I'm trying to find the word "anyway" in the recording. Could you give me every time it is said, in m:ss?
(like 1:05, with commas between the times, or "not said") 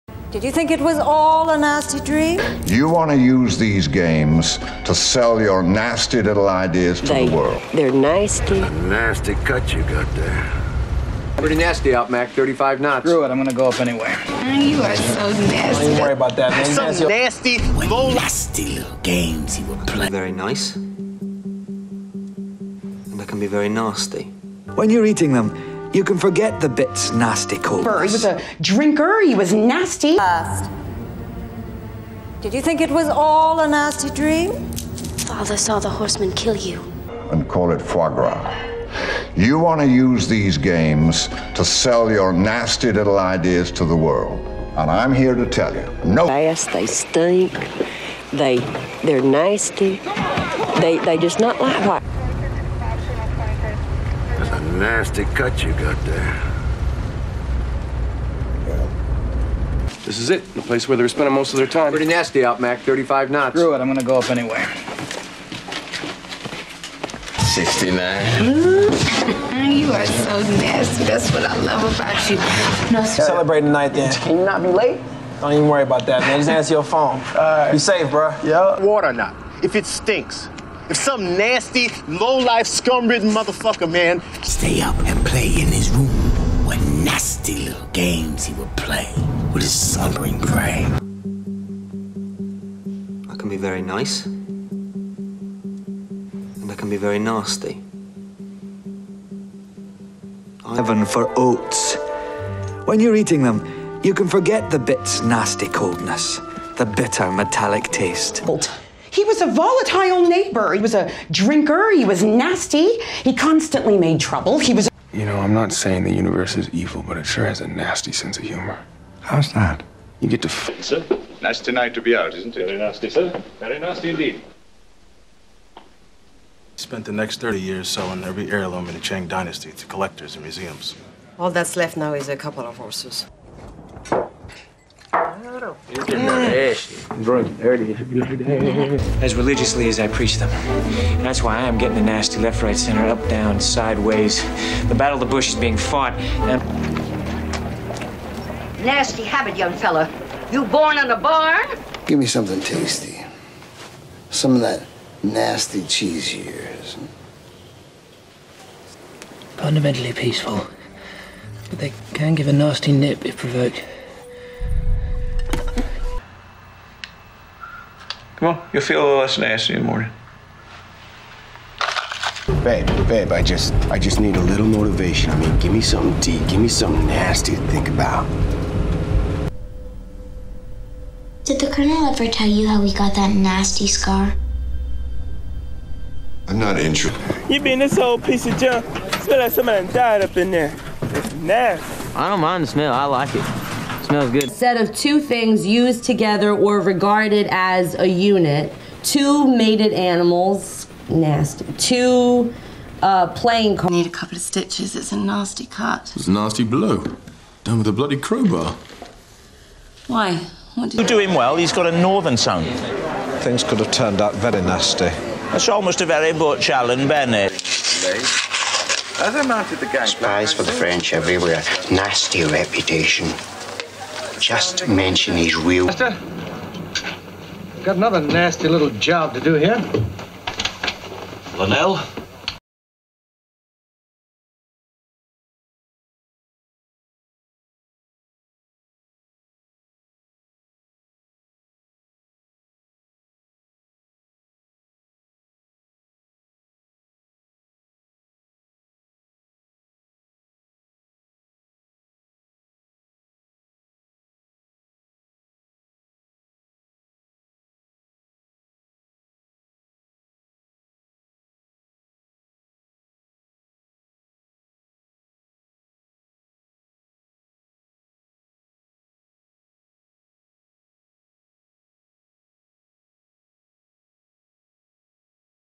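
0:13, 1:04.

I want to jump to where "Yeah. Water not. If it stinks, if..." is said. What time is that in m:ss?
1:18.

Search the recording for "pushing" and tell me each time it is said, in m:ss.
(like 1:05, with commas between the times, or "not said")
not said.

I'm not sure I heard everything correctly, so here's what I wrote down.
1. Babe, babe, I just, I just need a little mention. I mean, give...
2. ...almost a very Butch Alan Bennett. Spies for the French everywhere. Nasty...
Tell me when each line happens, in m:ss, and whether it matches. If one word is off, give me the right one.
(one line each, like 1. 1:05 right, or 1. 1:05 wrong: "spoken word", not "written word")
1. 2:52 wrong: "motivation", not "mention"
2. 3:35 right.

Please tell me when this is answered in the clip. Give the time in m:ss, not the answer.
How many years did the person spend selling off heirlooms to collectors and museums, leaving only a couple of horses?
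2:07.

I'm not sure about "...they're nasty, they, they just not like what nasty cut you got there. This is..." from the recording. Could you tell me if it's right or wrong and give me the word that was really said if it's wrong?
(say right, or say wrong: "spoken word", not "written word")
right.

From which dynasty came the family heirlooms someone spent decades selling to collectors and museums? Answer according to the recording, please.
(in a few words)
Chang dynasty.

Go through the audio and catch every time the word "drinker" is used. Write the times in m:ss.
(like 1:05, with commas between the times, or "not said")
0:28, 1:51.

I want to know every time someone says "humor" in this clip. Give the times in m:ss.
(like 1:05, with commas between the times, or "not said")
1:58.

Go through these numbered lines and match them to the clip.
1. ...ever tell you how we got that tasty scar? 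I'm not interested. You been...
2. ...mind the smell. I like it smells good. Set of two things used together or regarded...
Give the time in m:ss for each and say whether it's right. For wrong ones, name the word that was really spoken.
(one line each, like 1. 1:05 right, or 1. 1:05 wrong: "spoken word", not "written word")
1. 3:02 wrong: "nasty", not "tasty"
2. 3:12 right.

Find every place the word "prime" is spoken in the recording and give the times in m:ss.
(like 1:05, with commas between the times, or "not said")
not said.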